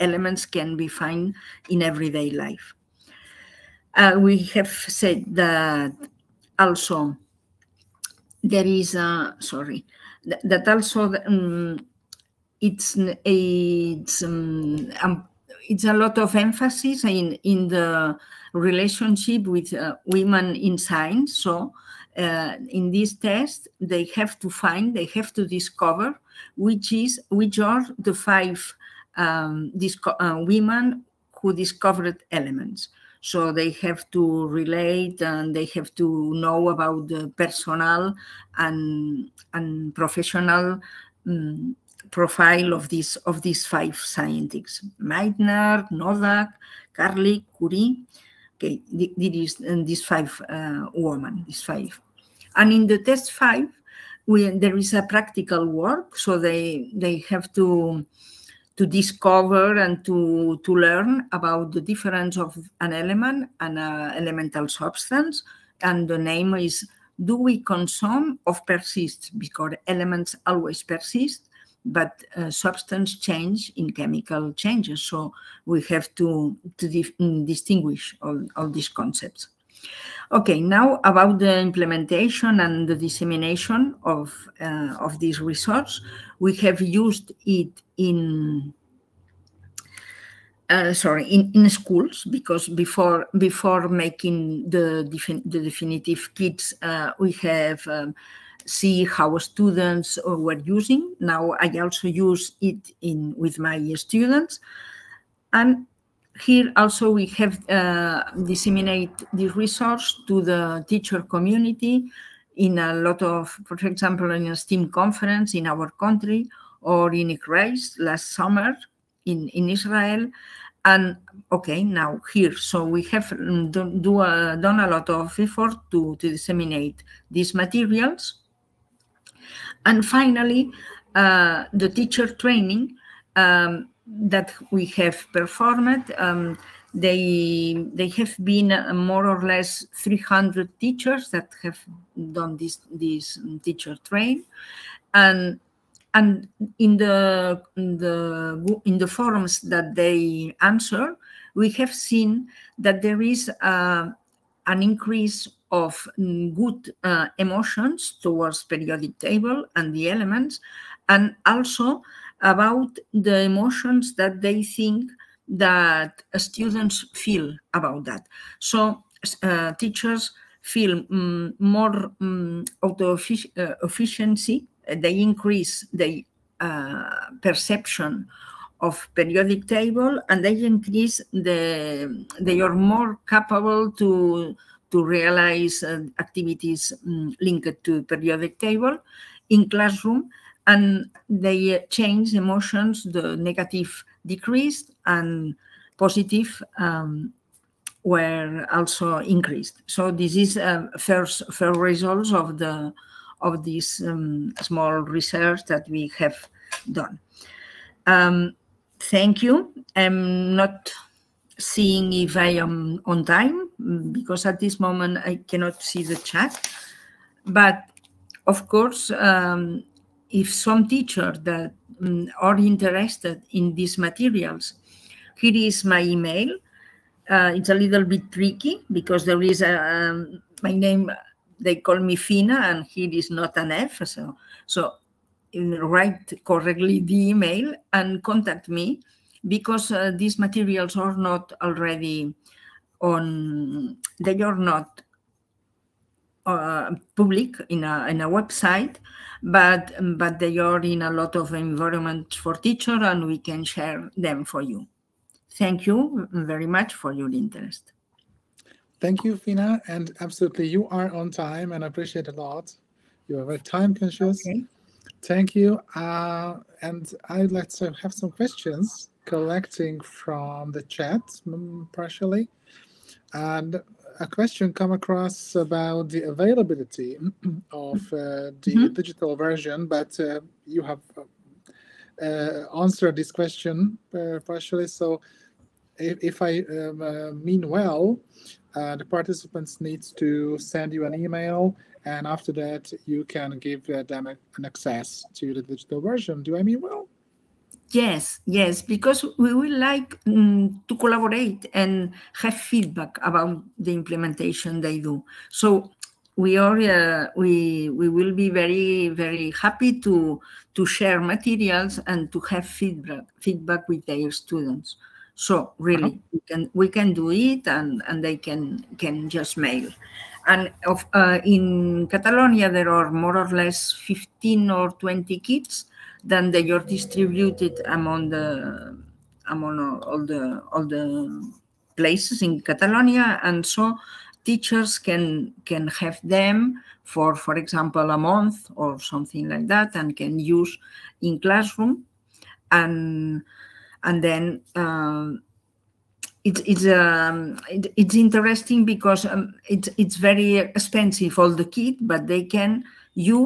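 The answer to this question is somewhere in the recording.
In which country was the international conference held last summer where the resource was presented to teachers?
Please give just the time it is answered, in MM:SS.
01:59.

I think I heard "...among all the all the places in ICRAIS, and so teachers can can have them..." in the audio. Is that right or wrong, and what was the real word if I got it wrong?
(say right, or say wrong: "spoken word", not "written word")
wrong: "Catalonia", not "ICRAIS".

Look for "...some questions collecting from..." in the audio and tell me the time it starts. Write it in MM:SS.
04:28.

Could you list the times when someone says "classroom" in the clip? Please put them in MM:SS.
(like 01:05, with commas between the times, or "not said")
03:09, 05:41.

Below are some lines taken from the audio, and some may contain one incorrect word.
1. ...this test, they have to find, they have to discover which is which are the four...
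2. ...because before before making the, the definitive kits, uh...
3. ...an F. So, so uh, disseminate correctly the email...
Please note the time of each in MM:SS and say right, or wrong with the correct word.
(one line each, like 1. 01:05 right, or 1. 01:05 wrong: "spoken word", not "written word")
1. 00:22 wrong: "five", not "four"
2. 01:32 right
3. 03:53 wrong: "write", not "disseminate".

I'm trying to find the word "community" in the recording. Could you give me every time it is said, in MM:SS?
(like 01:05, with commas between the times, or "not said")
01:51.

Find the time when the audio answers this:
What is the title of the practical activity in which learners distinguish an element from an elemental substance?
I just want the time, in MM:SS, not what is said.
01:07.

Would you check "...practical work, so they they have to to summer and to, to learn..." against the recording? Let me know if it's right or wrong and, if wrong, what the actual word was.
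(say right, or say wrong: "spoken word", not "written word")
wrong: "discover", not "summer".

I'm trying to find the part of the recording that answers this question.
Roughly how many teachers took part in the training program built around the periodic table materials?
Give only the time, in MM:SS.
02:20.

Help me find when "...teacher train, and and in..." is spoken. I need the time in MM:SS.
02:23.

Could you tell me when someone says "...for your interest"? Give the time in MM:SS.
04:16.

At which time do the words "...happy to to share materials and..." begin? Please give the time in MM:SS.
05:09.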